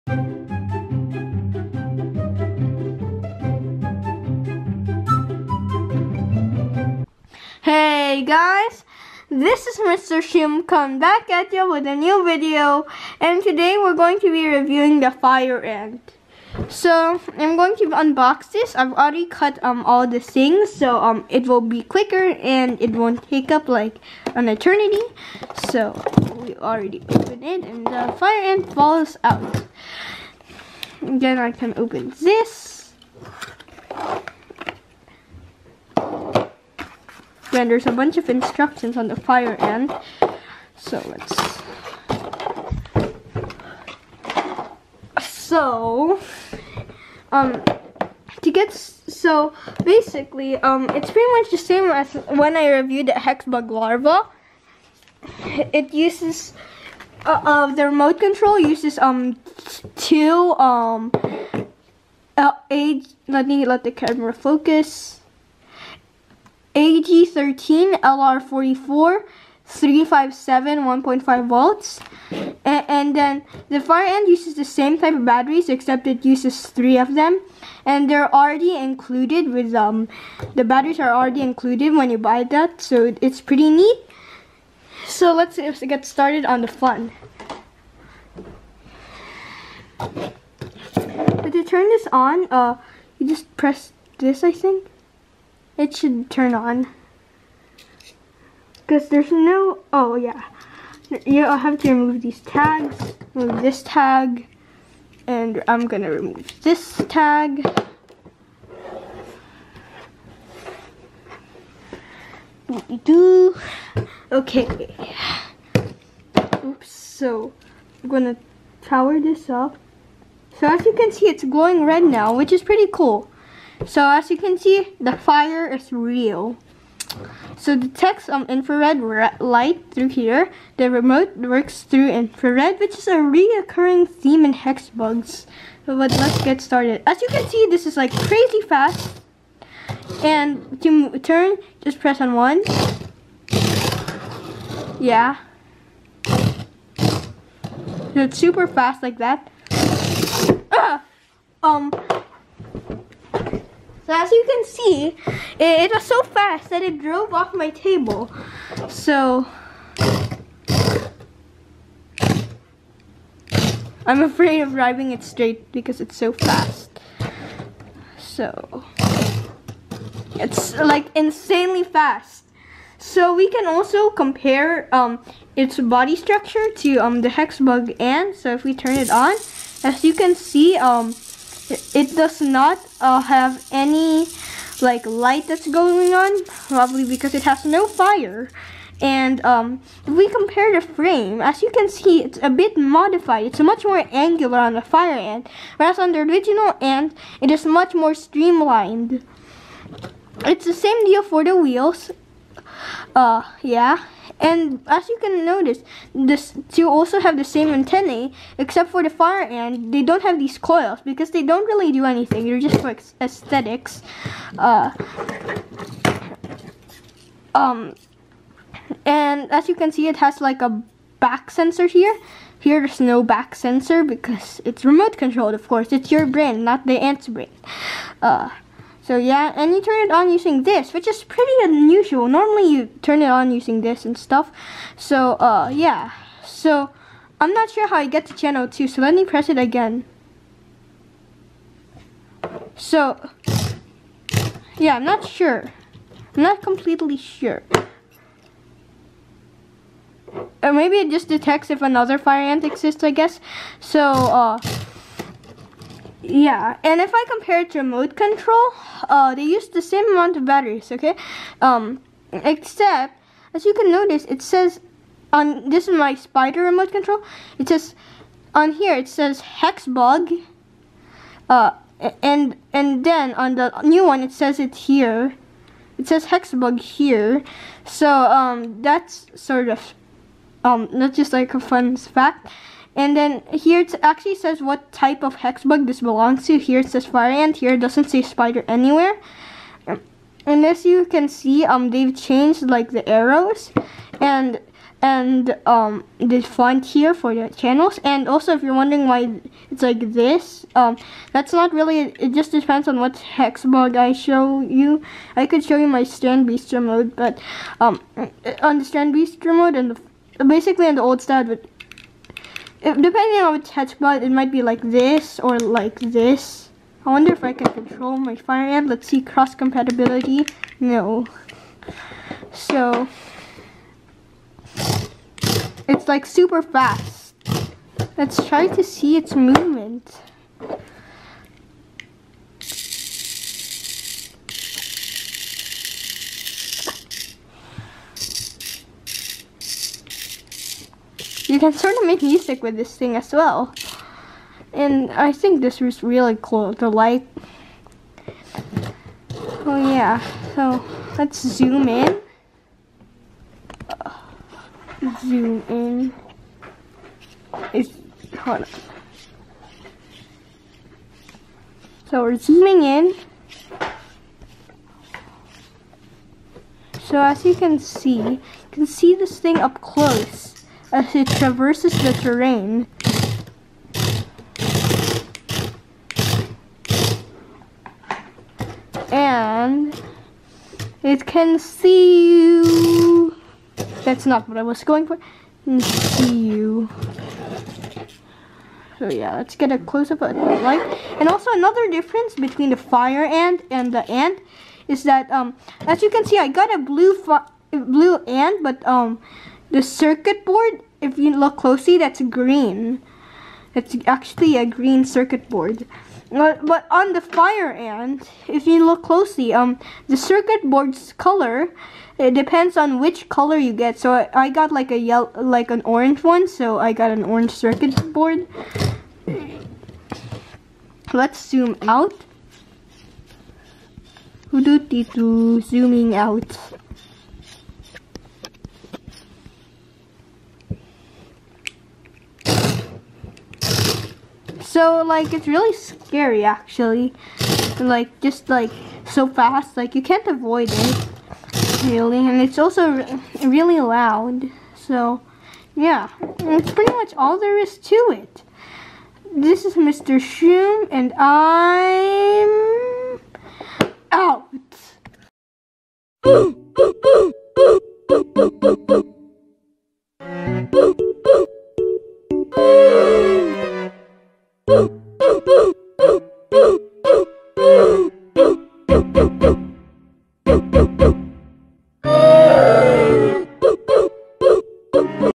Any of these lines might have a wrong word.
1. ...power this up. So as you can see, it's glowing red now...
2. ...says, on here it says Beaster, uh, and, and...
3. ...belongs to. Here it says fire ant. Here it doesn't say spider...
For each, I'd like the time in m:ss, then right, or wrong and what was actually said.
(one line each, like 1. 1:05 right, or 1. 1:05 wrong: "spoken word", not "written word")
1. 1:58 right
2. 4:27 wrong: "Hexbug", not "Beaster"
3. 4:46 right.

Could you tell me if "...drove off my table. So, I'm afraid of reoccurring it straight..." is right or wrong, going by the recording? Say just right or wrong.
wrong.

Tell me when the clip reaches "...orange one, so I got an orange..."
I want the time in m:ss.
6:55.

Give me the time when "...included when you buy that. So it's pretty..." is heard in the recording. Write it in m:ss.
1:21.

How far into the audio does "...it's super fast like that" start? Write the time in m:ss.
2:28.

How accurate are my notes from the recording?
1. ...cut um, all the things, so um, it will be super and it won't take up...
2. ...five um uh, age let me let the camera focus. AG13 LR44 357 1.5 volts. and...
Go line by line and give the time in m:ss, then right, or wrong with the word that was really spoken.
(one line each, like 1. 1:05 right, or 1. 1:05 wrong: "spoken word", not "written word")
1. 0:19 wrong: "quicker", not "super"
2. 0:59 wrong: "two", not "five".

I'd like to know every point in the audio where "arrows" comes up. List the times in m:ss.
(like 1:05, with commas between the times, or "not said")
4:53.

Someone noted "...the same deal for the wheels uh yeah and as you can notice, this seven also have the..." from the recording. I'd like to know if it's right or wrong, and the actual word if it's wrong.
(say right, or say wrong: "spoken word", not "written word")
wrong: "two", not "seven".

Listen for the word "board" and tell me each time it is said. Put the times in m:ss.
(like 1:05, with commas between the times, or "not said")
6:40, 6:45, 6:50, 6:58.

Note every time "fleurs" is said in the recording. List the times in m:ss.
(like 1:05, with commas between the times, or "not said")
not said.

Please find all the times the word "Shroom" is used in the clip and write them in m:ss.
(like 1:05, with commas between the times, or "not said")
0:10, 7:30.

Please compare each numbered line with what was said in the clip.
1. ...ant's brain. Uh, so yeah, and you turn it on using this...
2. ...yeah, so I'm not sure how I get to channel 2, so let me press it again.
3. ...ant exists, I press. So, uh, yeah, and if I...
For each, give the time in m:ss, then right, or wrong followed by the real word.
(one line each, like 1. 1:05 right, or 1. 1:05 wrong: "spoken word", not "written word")
1. 3:46 right
2. 3:55 right
3. 4:12 wrong: "guess", not "press".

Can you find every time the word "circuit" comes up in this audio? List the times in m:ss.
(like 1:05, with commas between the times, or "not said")
6:39, 6:45, 6:50, 6:57.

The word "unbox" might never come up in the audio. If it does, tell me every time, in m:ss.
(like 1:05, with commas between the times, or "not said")
0:17.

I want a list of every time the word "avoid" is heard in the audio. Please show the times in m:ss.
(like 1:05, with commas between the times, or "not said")
7:20.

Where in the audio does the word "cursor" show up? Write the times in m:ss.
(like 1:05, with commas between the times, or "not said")
not said.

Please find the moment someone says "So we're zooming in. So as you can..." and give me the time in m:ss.
6:02.